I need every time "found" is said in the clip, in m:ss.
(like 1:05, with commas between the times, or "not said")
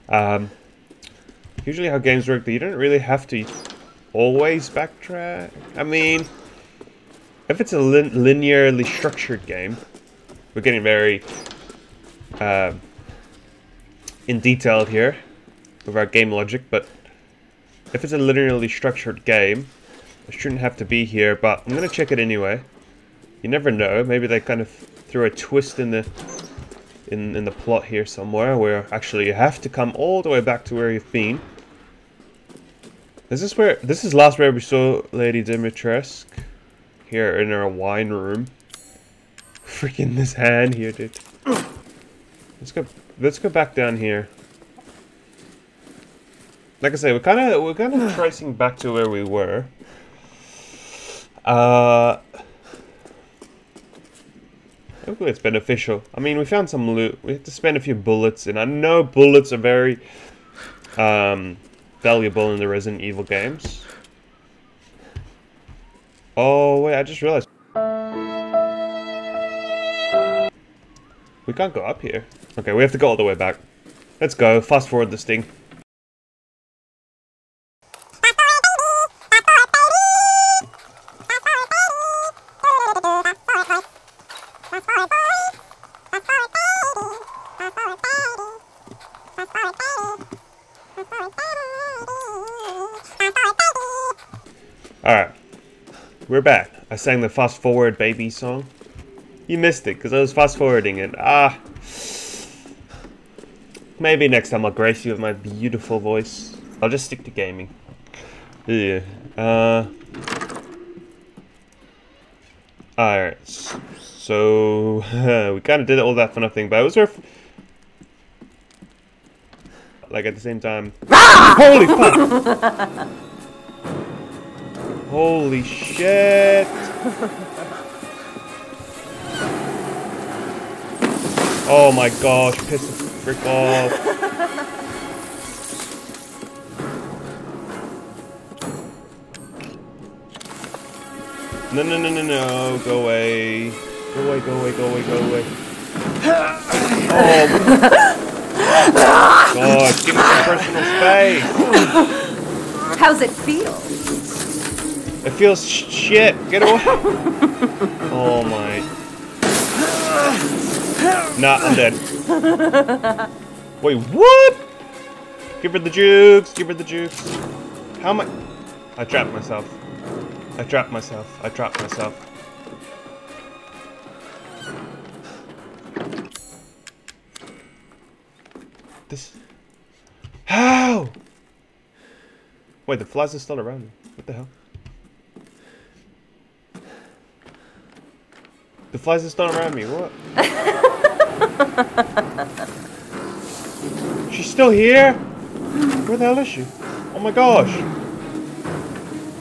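0:56.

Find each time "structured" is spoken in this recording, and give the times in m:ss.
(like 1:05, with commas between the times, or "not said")
0:08, 0:18.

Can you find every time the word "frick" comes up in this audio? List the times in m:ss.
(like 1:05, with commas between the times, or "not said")
2:13.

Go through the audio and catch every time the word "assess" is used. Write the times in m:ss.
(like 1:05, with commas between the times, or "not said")
not said.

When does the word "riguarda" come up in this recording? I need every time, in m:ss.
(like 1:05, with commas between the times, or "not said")
not said.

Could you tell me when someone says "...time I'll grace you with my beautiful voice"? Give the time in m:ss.
1:44.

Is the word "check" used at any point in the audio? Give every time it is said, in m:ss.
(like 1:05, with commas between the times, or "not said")
0:21.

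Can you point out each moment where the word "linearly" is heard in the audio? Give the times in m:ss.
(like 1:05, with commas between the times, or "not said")
0:08, 0:18.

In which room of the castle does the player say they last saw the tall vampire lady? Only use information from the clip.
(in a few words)
Wine room.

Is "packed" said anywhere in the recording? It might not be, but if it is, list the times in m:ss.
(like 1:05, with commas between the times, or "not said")
not said.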